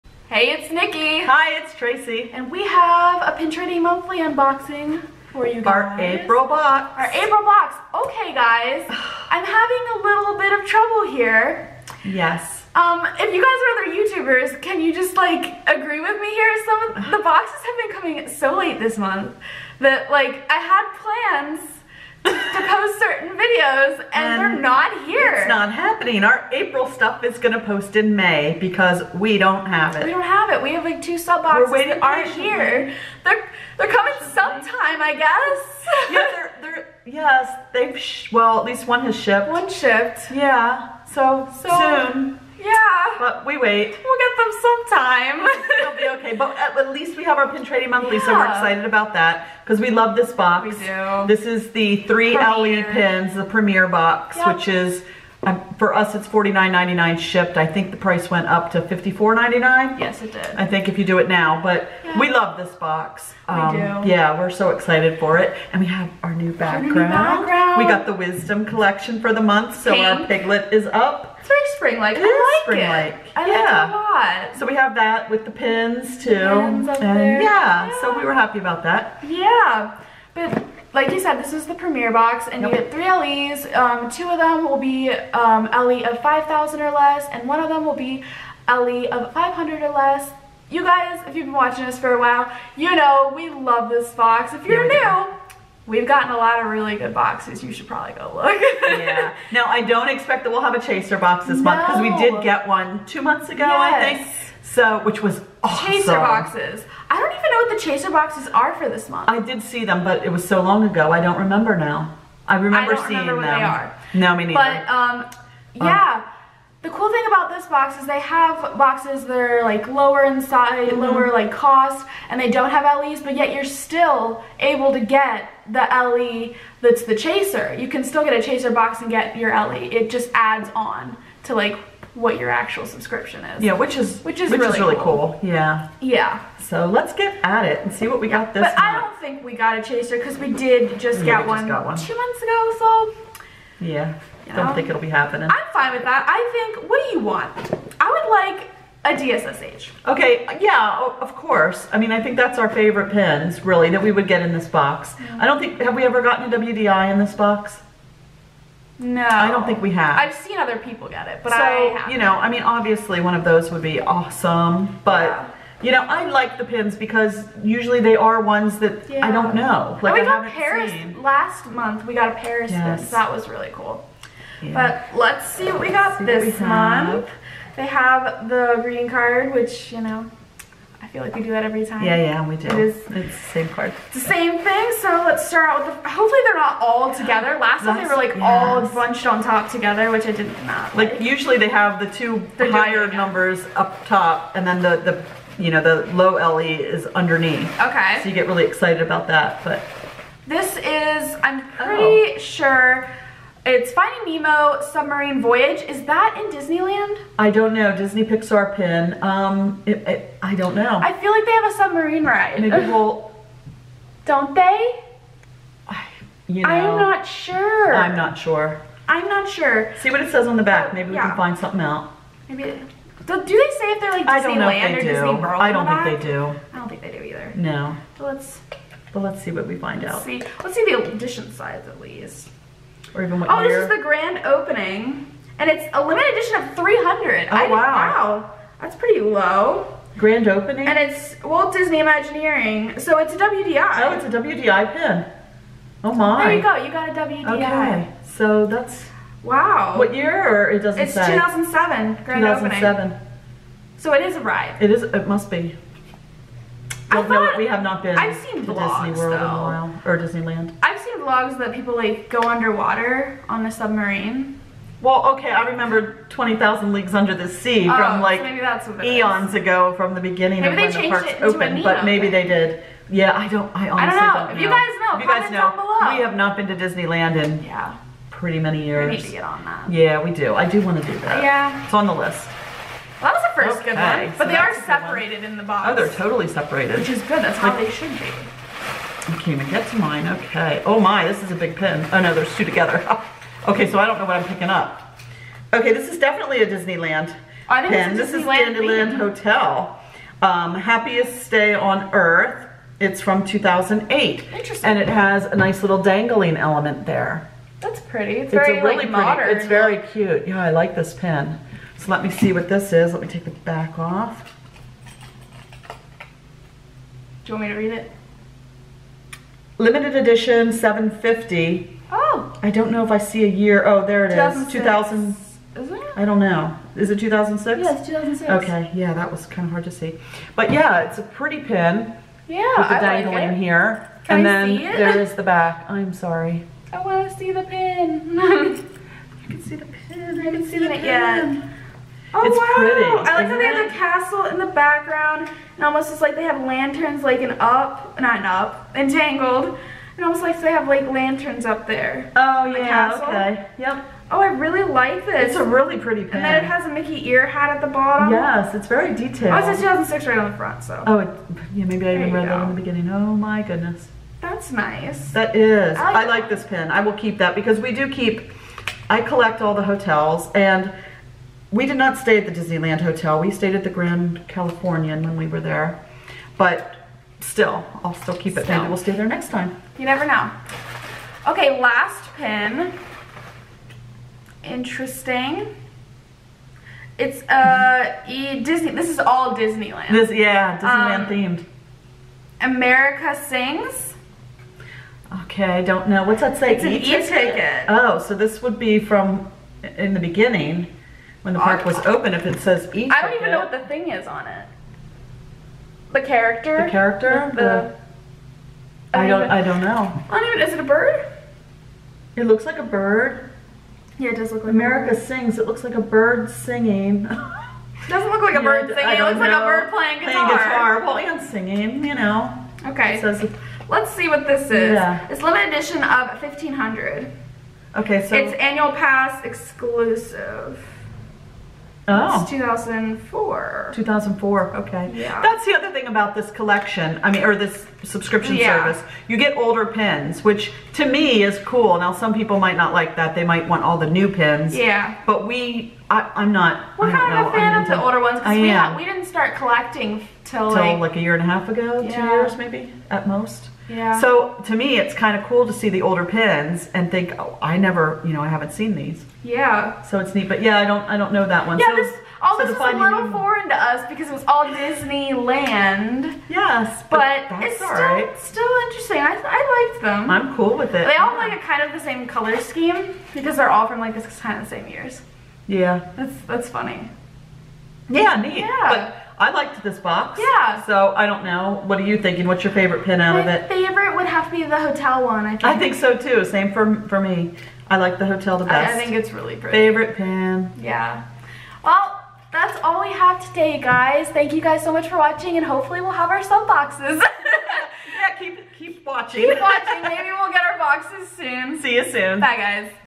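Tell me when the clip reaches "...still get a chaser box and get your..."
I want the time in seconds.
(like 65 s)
128 s.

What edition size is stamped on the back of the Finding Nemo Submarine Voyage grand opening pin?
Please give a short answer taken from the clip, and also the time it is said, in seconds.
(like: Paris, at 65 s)
300, at 236 s.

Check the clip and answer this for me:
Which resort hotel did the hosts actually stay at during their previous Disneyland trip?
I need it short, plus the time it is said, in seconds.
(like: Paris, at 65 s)
Grand Californian, at 373 s.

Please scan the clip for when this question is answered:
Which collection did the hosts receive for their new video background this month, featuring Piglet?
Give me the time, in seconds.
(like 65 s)
68 s.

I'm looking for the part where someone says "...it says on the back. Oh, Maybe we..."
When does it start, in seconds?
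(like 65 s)
220 s.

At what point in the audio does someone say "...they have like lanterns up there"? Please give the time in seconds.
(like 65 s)
350 s.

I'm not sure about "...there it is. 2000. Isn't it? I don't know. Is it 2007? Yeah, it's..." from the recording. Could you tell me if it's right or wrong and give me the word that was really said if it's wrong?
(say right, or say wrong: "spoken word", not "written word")
wrong: "2006", not "2007".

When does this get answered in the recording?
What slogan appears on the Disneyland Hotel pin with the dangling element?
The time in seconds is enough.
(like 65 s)
300 s.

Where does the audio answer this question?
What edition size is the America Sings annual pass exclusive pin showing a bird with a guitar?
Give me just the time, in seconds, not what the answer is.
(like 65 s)
425 s.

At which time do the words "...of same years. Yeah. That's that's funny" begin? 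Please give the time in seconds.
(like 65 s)
474 s.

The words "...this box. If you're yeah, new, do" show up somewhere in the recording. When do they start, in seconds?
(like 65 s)
93 s.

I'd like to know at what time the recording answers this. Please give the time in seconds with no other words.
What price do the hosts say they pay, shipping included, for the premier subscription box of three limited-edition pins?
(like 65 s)
56 s.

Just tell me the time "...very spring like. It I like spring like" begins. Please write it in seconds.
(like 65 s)
71 s.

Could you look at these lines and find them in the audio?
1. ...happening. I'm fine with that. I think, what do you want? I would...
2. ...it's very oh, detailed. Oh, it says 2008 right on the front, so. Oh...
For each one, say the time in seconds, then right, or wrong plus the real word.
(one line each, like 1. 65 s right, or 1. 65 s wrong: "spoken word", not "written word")
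1. 145 s right
2. 358 s wrong: "2006", not "2008".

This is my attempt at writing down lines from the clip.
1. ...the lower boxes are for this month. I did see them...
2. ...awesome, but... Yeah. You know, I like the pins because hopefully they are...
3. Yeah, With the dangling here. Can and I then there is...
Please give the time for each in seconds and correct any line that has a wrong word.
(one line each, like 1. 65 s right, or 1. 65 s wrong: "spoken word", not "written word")
1. 107 s wrong: "chaser", not "lower"
2. 164 s wrong: "usually", not "hopefully"
3. 332 s right.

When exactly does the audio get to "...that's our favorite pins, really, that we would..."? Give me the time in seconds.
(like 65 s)
152 s.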